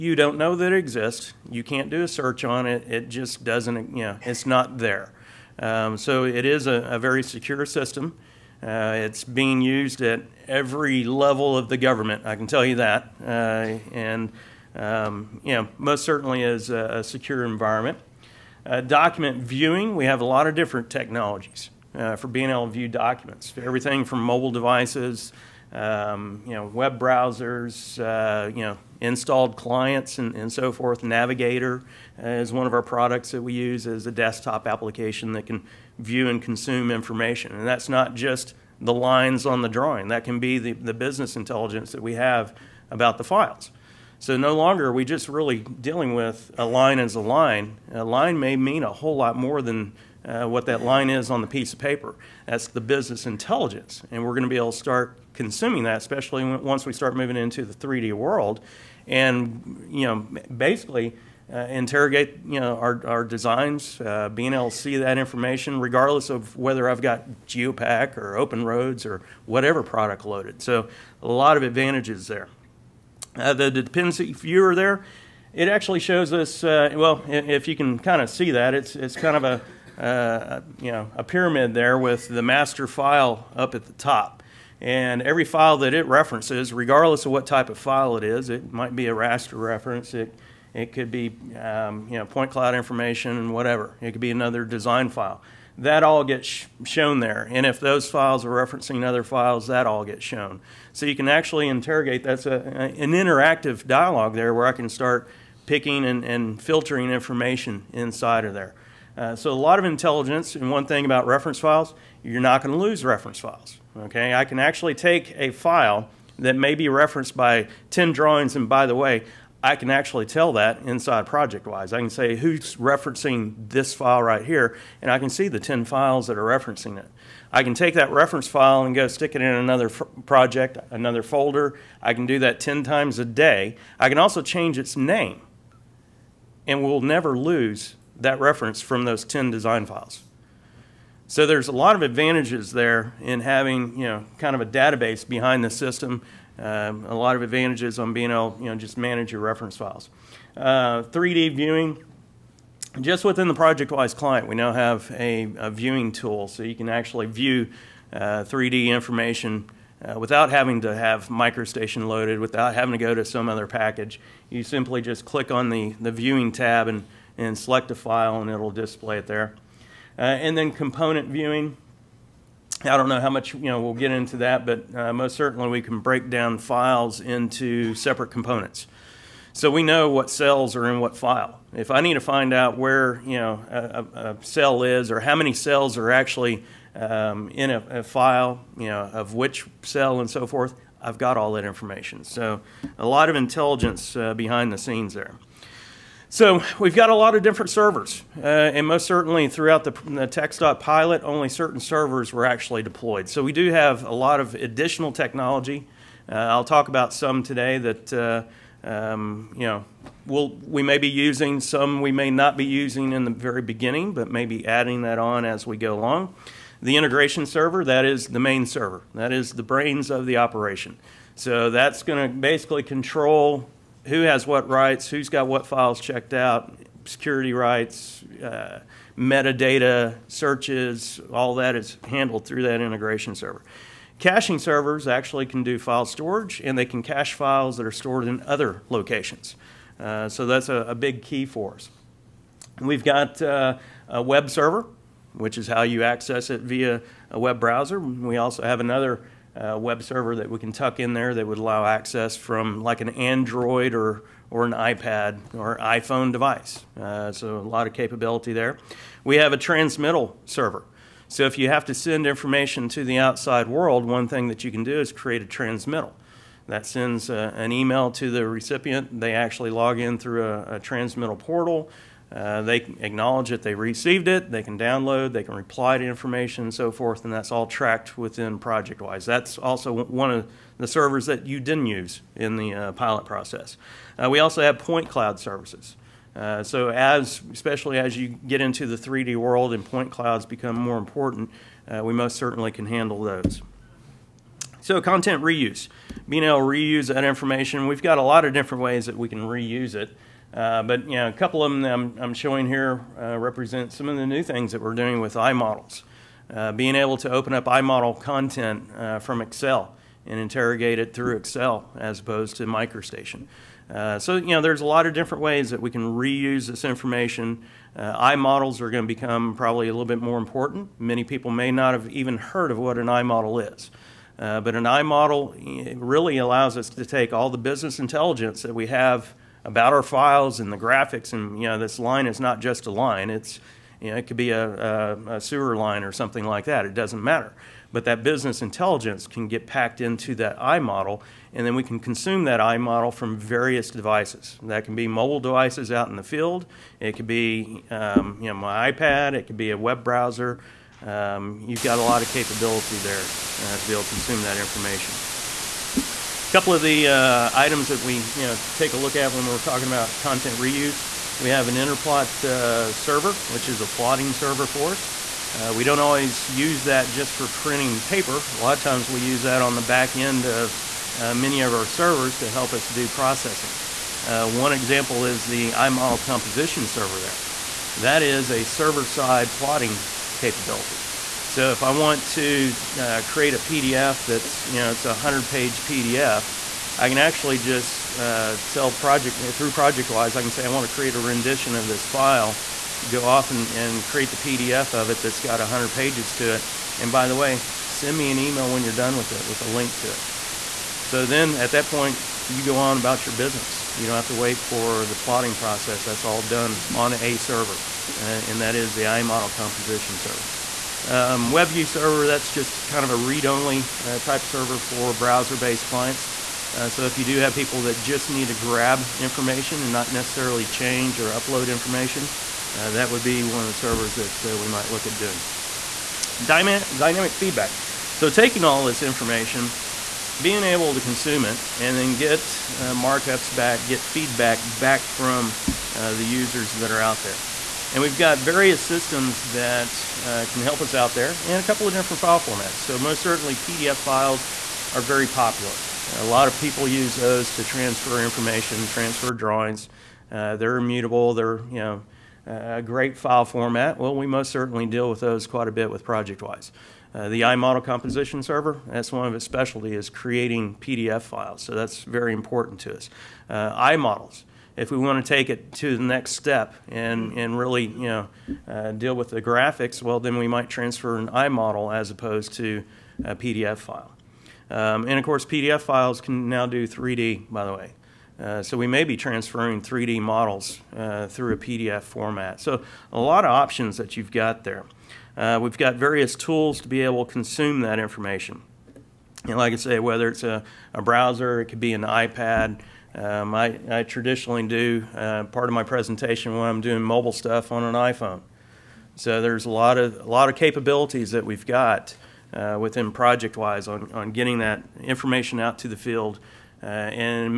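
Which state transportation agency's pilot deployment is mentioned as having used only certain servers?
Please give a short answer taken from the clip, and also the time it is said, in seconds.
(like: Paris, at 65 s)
TxDOT, at 200 s.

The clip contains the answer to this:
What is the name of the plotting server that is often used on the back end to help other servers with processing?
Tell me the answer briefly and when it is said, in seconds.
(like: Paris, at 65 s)
InterPlot, at 361 s.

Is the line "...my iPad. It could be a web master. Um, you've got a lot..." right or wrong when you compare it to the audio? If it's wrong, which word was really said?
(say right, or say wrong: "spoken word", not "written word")
wrong: "browser", not "master".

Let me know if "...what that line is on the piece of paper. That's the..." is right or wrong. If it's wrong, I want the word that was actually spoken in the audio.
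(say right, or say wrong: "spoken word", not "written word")
right.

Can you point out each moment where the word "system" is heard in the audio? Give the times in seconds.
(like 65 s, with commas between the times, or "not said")
7 s, 145 s, 438 s.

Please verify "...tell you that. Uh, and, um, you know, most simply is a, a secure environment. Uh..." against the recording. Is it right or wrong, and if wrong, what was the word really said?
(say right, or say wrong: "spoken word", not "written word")
wrong: "certainly", not "simply".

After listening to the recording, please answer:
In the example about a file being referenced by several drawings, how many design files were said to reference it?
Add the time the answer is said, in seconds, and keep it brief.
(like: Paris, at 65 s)
10, at 117 s.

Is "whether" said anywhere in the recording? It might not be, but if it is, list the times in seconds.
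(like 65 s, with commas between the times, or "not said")
66 s, 489 s.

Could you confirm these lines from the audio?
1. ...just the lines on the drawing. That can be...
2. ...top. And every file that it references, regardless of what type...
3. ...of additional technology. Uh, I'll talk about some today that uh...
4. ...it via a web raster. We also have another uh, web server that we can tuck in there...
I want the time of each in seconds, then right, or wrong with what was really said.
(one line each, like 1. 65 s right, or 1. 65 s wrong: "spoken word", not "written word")
1. 38 s right
2. 83 s right
3. 204 s right
4. 246 s wrong: "browser", not "raster".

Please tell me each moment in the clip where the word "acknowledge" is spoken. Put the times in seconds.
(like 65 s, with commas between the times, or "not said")
272 s.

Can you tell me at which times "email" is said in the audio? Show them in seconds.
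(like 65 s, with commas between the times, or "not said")
267 s, 398 s.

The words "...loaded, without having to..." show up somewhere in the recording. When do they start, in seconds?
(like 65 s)
162 s.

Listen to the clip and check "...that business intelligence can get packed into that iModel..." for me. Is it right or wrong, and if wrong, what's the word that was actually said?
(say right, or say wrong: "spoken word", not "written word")
right.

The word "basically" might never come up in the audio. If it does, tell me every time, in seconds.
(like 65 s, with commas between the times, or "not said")
60 s, 222 s.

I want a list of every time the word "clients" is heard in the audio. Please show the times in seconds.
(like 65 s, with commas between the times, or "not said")
29 s, 154 s, 415 s.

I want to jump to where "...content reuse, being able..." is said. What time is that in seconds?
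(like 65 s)
294 s.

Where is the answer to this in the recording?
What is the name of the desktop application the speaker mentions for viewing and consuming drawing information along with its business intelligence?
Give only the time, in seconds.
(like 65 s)
31 s.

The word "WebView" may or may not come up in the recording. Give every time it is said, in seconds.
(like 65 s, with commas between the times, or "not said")
411 s.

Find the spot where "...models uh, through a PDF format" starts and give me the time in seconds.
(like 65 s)
480 s.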